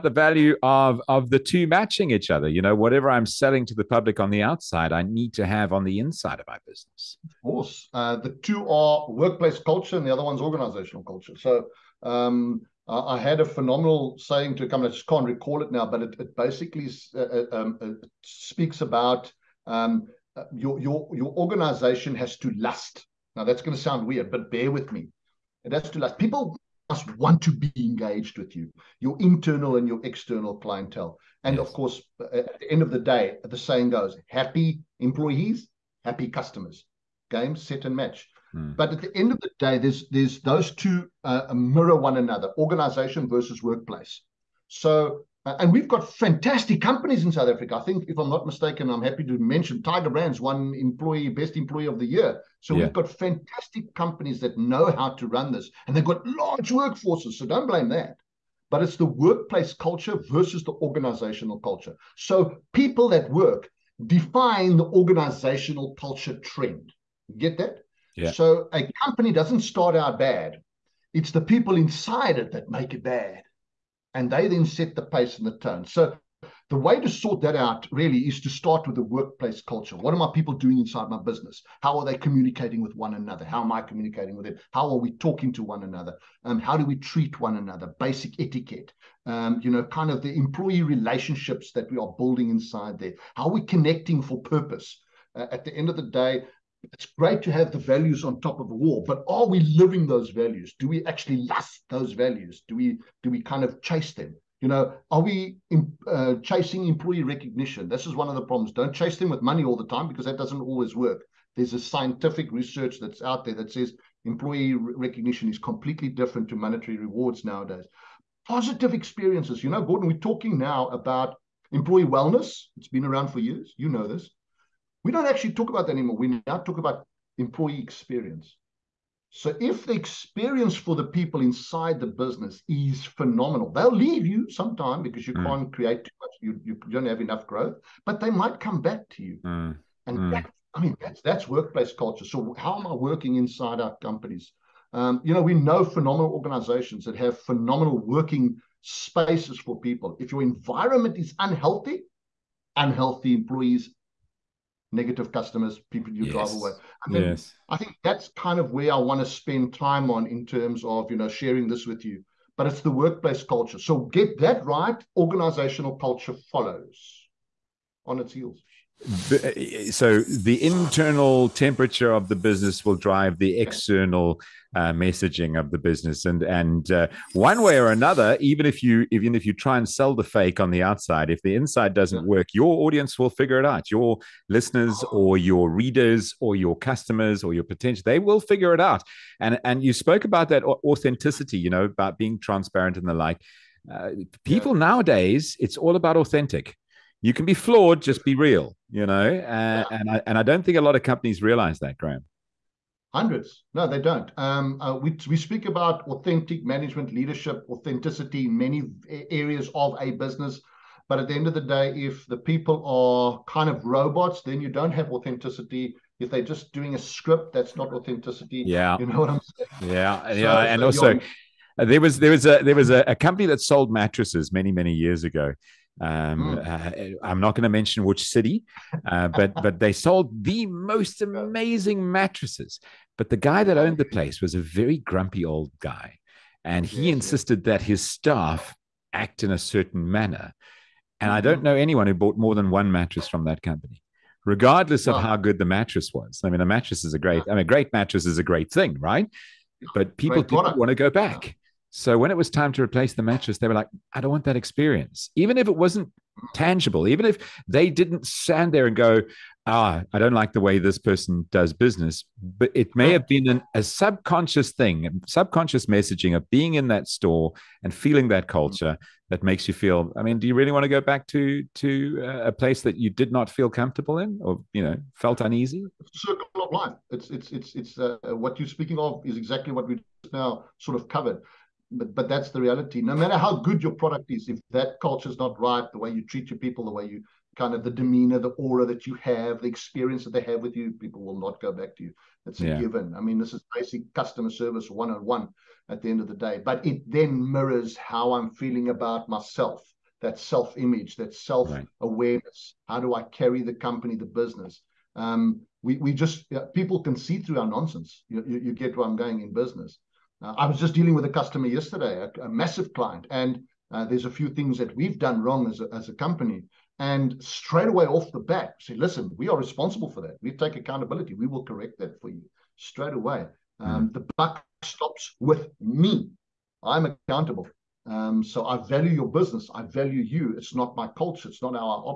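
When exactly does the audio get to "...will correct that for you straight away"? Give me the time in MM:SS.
05:21.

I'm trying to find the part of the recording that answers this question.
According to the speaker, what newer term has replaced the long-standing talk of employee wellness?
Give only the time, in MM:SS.
02:07.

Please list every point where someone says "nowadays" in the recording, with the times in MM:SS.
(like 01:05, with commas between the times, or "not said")
01:57, 03:14.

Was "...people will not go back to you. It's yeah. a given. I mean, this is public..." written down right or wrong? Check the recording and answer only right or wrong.
wrong.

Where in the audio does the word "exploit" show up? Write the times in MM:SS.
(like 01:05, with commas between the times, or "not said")
not said.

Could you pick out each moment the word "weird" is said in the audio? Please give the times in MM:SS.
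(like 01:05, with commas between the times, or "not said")
00:24.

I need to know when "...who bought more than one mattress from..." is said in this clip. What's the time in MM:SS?
04:02.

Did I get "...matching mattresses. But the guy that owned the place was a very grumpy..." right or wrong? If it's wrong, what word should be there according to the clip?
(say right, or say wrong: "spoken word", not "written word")
wrong: "amazing", not "matching".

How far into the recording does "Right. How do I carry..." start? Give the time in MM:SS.
05:02.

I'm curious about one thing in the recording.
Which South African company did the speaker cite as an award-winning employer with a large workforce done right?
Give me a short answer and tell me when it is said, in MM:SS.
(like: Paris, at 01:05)
Tiger Brands, at 00:49.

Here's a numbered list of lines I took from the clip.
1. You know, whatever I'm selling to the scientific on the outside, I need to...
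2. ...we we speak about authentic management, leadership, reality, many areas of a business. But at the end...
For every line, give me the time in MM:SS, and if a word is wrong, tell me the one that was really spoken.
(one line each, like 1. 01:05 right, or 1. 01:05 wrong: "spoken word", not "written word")
1. 00:02 wrong: "public", not "scientific"
2. 03:24 wrong: "authenticity", not "reality".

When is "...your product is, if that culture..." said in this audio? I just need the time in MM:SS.
04:43.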